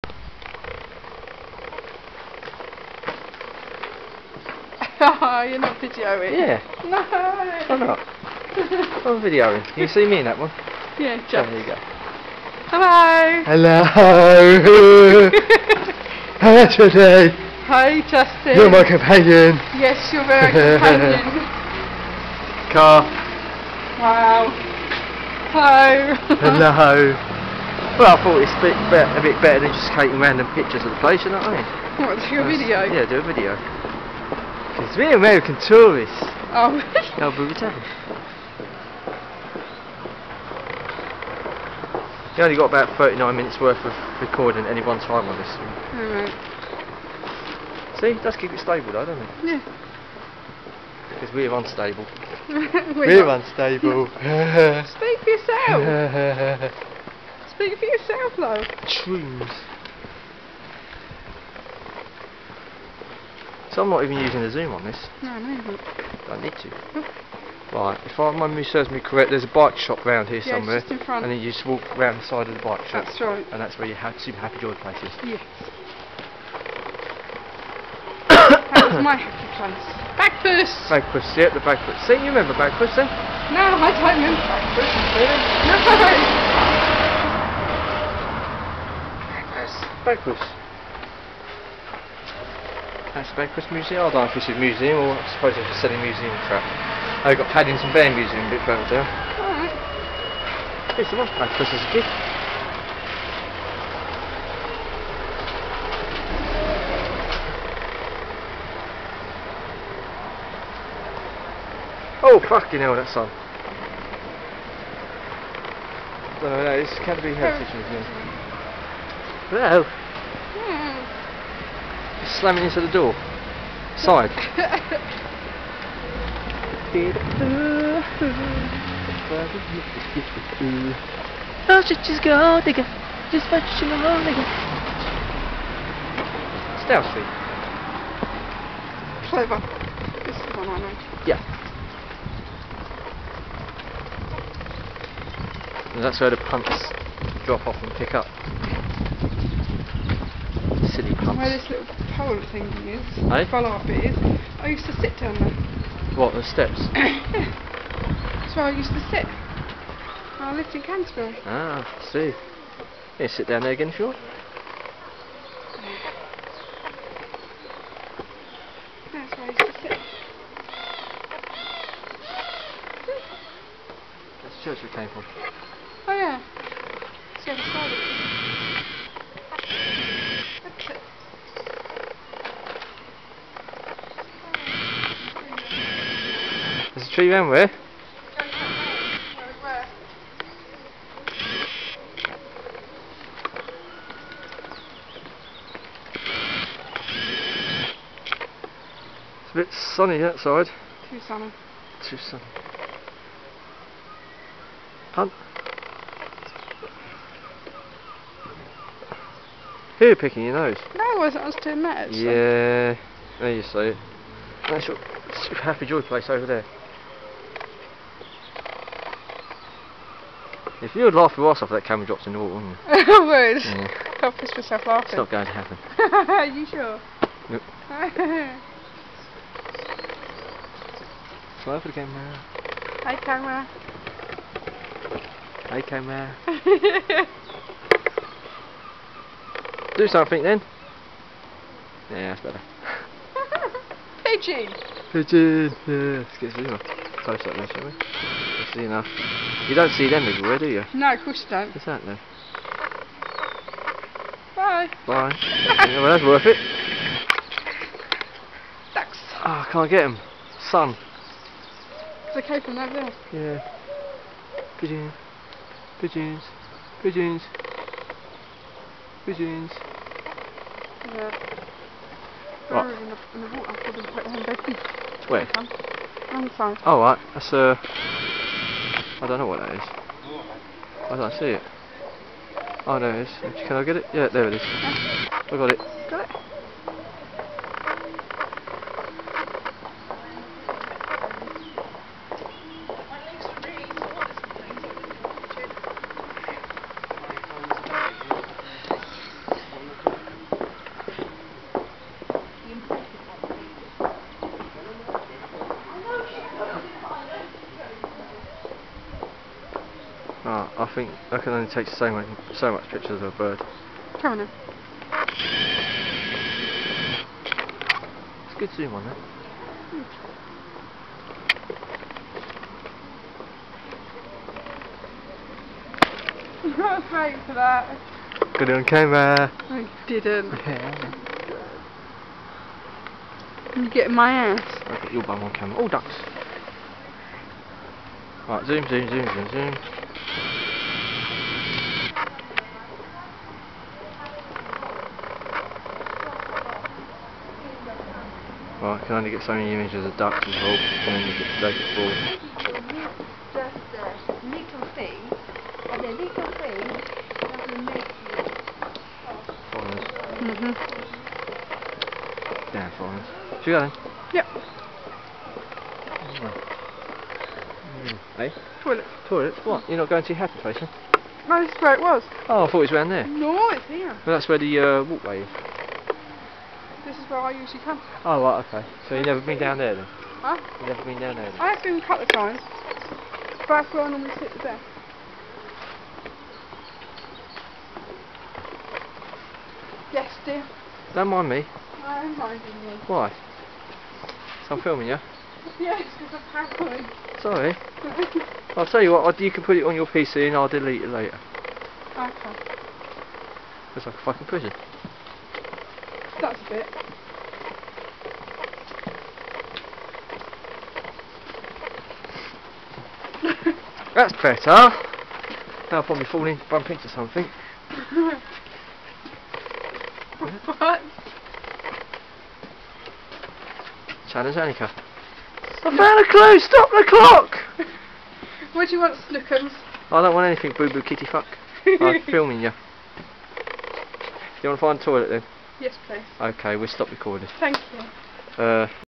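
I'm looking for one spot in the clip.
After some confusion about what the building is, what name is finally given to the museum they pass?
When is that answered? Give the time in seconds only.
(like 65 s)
116 s.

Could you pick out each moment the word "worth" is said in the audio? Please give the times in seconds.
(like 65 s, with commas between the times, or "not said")
43 s, 256 s.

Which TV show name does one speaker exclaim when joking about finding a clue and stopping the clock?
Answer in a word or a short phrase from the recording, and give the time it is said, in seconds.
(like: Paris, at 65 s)
Challenge Anneka, at 424 s.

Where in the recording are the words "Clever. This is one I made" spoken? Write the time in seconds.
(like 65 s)
139 s.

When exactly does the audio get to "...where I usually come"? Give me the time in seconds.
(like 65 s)
377 s.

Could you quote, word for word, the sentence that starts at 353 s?
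Just a uh, little thing, and a little thing make you...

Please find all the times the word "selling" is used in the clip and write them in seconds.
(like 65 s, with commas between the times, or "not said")
95 s.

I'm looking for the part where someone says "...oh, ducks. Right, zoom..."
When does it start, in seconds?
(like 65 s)
335 s.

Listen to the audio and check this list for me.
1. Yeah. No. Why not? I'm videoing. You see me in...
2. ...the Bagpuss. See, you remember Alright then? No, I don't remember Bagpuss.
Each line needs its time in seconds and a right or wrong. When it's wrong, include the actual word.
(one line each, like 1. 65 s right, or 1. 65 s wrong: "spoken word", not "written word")
1. 6 s right
2. 81 s wrong: "Bagpuss", not "Alright".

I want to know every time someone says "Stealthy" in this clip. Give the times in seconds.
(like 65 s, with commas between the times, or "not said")
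124 s.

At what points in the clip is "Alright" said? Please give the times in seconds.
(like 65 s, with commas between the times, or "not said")
46 s, 99 s.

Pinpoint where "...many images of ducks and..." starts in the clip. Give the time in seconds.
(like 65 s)
349 s.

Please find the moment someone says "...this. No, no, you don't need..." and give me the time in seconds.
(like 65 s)
64 s.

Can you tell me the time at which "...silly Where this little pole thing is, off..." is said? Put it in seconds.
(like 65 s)
150 s.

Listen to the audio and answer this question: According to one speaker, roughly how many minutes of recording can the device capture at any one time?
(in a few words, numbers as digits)
39 minutes.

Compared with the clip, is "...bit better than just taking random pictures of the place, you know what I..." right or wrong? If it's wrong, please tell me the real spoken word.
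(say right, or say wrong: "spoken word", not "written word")
right.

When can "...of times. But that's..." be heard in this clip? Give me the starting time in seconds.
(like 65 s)
382 s.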